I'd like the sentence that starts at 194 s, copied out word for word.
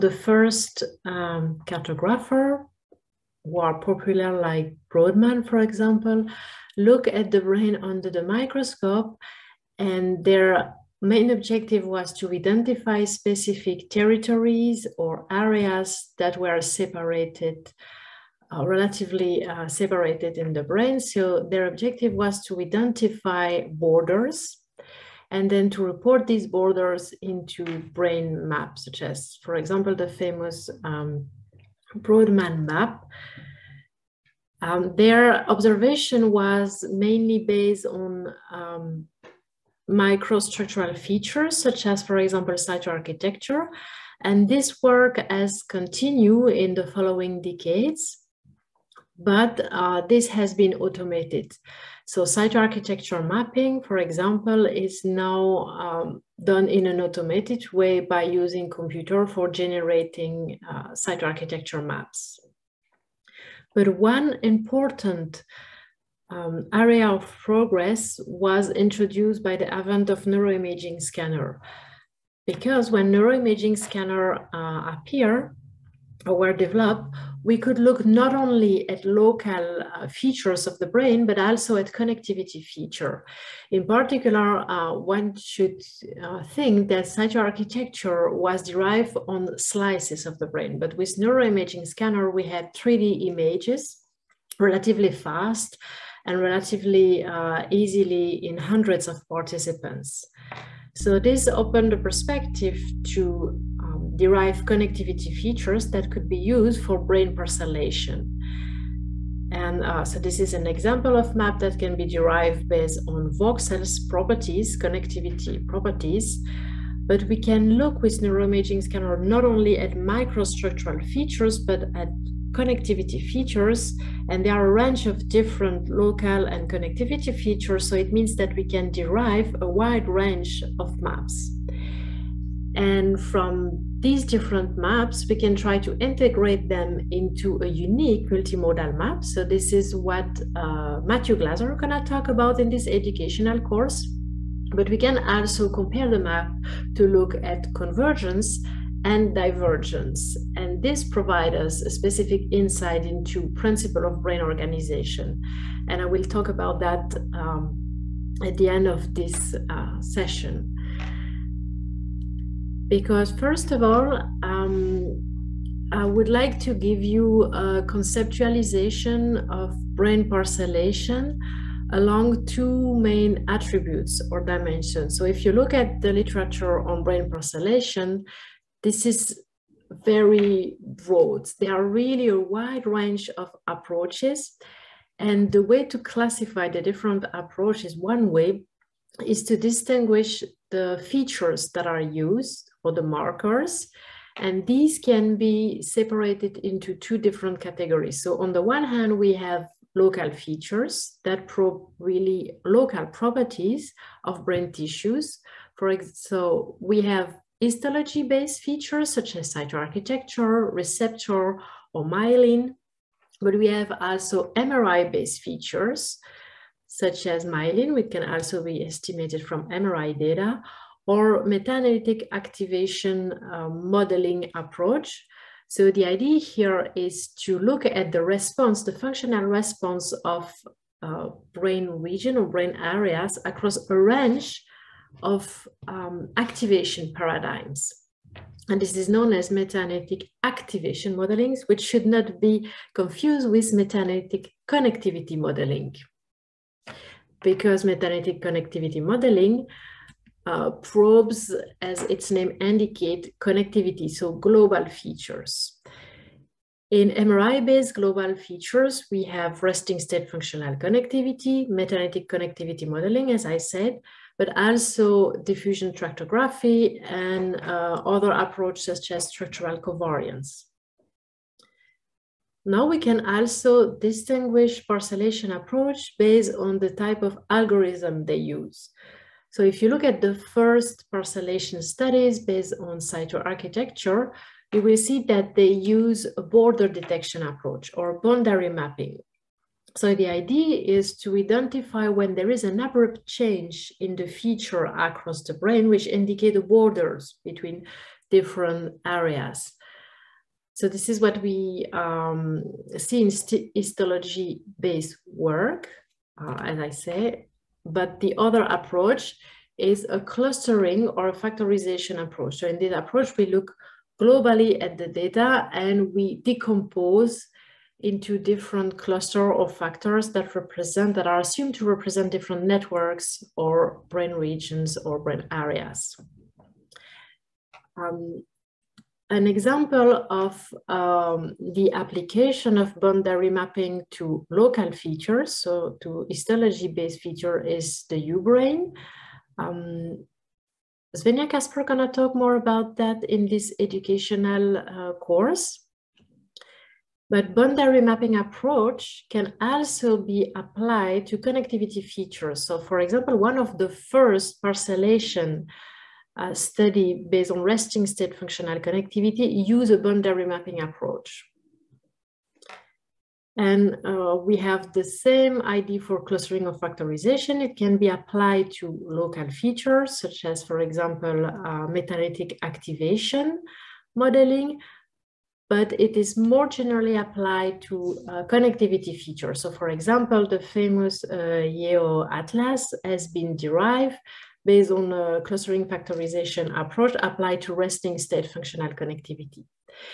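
And these can be separated into two different categories.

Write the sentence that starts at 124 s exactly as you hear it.
And there are a range of different local and connectivity features.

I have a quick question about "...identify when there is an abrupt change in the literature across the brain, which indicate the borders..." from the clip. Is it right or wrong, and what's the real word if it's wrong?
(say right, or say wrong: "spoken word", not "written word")
wrong: "feature", not "literature".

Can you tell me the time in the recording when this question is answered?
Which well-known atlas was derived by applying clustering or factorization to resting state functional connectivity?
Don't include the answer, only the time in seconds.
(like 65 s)
381 s.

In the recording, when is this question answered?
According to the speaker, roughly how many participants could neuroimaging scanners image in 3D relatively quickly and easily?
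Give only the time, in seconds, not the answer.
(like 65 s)
98 s.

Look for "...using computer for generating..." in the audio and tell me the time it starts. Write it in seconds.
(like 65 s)
58 s.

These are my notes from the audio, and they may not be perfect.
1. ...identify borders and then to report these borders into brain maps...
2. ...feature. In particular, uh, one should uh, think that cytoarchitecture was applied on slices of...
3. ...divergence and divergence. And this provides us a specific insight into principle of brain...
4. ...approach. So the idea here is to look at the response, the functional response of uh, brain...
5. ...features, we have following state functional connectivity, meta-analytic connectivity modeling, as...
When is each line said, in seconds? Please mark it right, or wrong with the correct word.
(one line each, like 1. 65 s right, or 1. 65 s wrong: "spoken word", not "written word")
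1. 22 s right
2. 82 s wrong: "derived", not "applied"
3. 147 s wrong: "convergence", not "divergence"
4. 224 s right
5. 258 s wrong: "resting", not "following".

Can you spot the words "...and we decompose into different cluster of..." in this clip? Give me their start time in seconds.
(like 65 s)
315 s.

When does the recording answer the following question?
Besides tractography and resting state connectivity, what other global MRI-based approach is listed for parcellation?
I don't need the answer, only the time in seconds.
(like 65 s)
269 s.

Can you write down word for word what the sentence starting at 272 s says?
Now we can also distinguish parcellation approach based on the type of algorithm they use.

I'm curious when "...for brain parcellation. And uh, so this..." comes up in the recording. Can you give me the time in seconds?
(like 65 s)
106 s.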